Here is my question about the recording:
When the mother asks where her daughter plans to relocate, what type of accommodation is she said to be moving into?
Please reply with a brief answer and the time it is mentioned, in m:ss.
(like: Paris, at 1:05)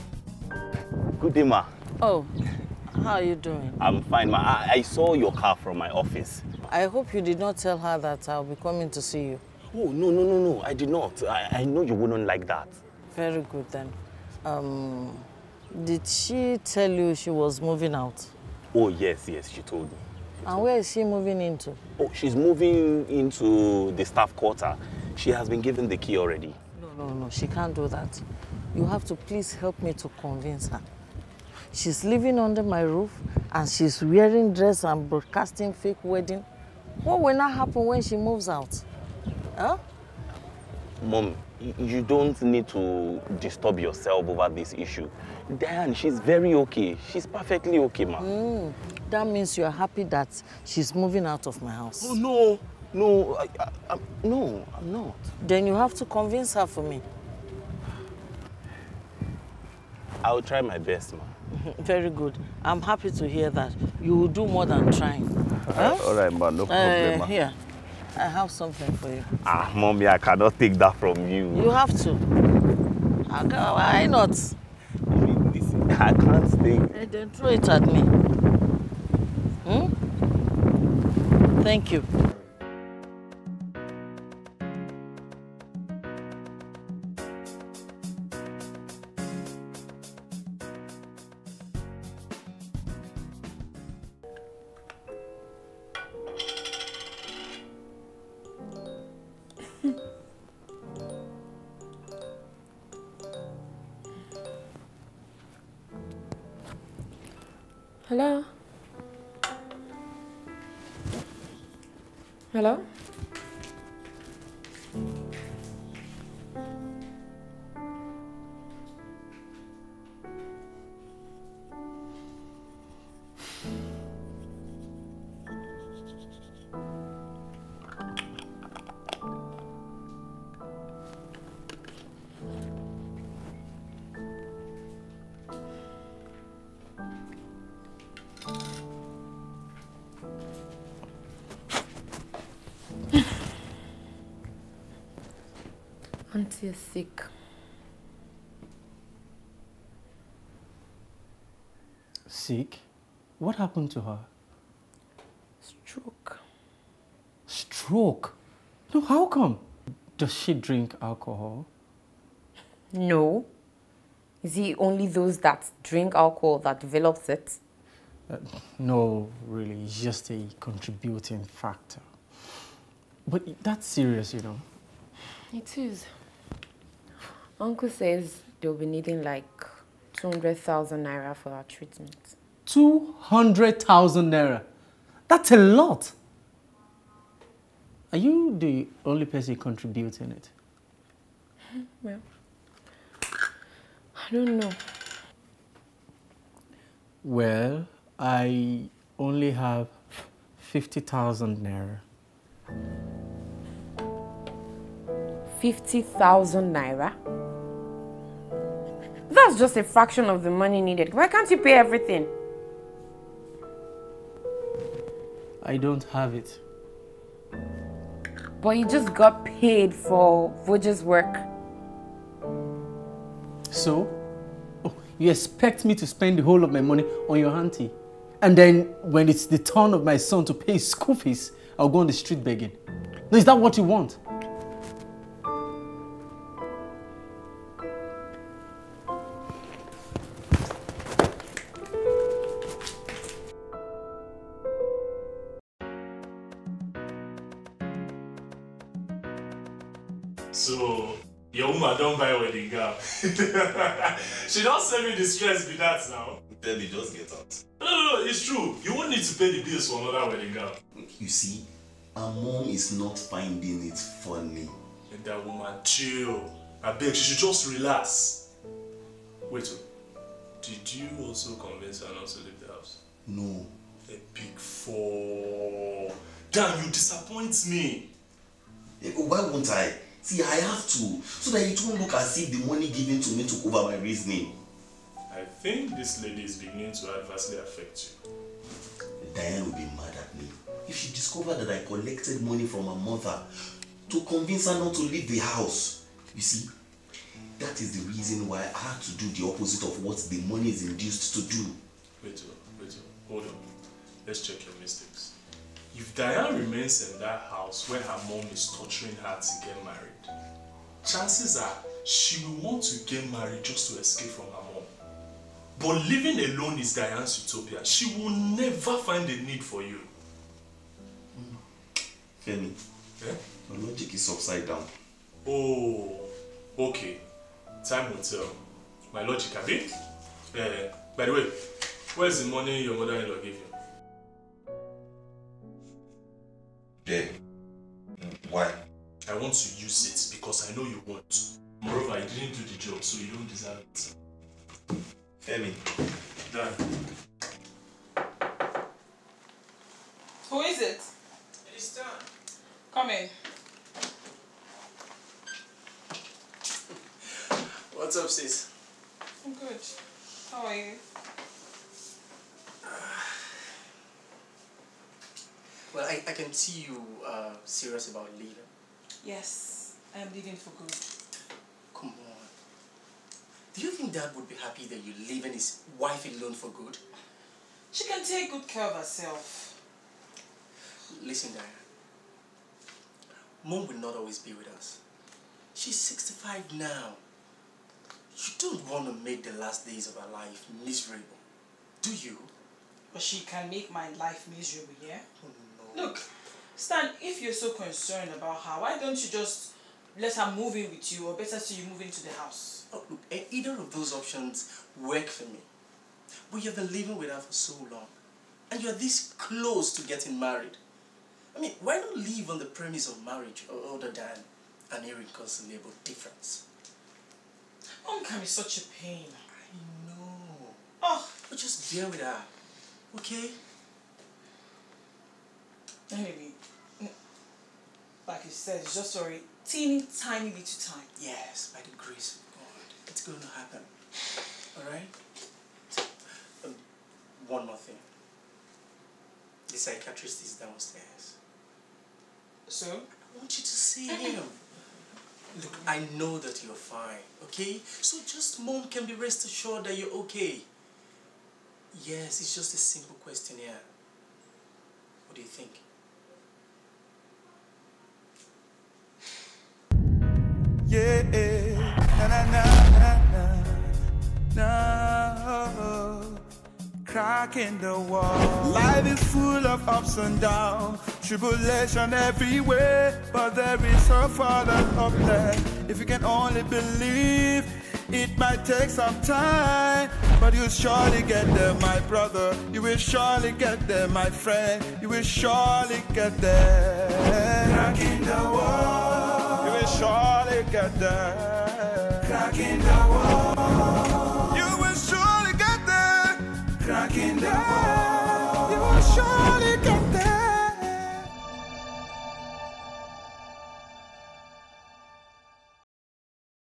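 Staff quarter, at 0:24.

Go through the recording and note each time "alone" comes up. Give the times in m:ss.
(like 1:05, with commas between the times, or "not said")
5:16, 6:16.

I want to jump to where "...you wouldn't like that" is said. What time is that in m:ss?
0:11.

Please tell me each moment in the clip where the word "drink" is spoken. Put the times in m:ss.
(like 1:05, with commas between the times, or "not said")
2:40, 2:45.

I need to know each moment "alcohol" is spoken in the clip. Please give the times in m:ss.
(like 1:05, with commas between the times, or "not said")
2:40, 2:46.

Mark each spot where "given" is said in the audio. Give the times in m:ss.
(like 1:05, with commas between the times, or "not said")
0:25, 4:42.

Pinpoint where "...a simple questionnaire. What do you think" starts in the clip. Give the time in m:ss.
7:32.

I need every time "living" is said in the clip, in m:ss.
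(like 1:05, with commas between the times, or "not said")
0:32, 5:16, 6:46.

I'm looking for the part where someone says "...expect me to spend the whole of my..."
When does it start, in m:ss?
3:45.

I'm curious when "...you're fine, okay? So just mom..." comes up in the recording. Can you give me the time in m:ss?
7:26.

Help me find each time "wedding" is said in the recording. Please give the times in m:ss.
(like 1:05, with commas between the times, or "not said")
0:36, 4:12, 4:20.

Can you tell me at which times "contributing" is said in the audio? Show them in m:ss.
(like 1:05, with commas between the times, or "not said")
2:50, 3:09.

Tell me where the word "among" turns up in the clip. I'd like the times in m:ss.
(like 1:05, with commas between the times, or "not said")
not said.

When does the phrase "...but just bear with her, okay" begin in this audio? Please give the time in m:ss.
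7:01.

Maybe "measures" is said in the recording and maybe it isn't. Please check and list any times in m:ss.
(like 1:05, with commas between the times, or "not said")
not said.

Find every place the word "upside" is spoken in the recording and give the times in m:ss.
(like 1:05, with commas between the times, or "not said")
5:24.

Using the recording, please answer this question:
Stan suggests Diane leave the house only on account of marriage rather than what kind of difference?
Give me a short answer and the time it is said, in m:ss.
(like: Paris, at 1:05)
Irreconcilable difference, at 6:55.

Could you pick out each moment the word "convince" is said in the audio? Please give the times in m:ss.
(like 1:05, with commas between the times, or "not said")
0:30, 0:56, 4:31, 4:54.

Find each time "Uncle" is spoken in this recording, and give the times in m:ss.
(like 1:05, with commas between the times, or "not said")
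2:57.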